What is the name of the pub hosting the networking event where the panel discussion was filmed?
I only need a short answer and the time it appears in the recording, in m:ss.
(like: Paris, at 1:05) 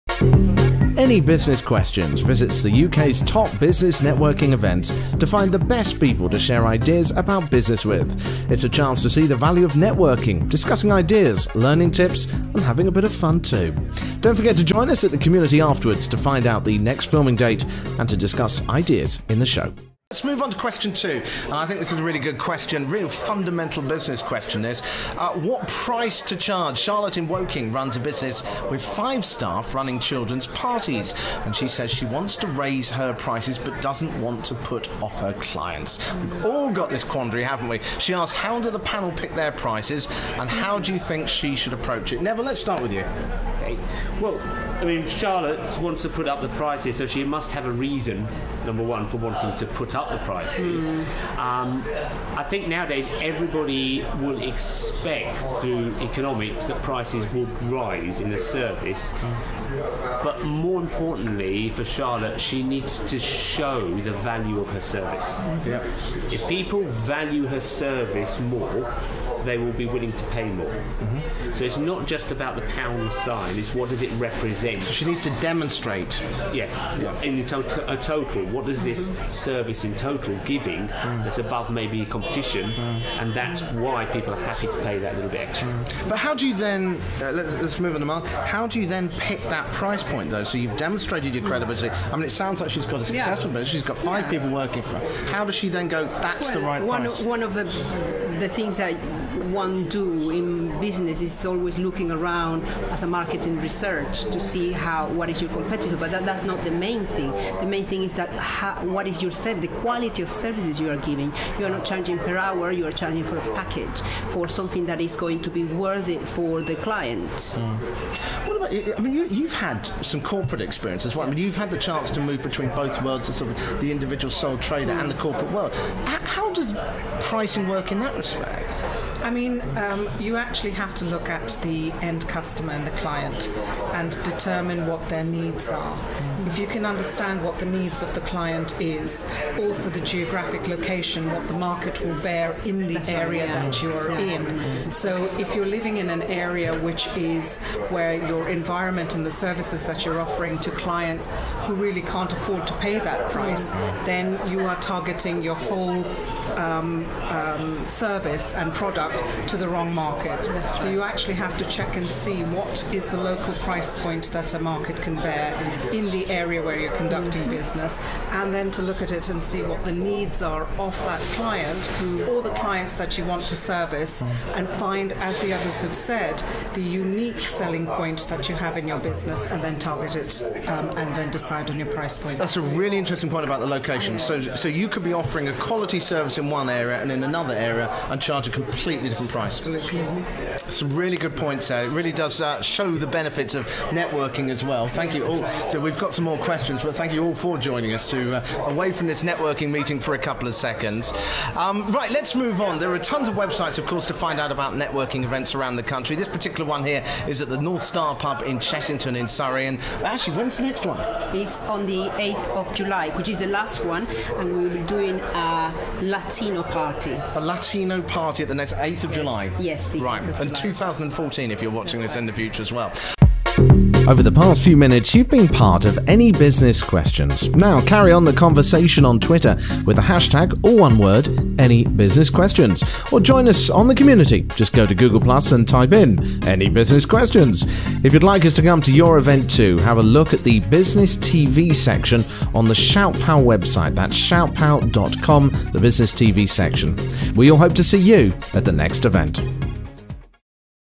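North Star, at 3:27.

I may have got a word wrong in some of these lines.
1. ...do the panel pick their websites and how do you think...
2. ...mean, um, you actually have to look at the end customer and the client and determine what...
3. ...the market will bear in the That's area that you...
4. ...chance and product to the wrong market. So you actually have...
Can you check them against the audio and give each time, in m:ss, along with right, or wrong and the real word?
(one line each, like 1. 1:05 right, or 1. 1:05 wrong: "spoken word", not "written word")
1. 0:38 wrong: "prices", not "websites"
2. 2:09 right
3. 2:21 right
4. 2:37 wrong: "service", not "chance".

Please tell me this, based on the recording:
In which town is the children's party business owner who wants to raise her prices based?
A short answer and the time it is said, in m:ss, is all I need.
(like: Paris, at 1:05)
Woking, at 0:27.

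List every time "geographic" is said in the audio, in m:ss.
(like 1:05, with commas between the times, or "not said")
2:20.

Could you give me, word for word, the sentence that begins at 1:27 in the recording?
Uh, let's, let's move on a mile.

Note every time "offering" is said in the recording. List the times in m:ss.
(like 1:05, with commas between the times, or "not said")
2:30, 3:05.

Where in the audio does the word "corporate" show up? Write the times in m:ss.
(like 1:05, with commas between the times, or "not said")
2:00, 2:05.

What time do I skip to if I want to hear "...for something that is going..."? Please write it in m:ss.
1:54.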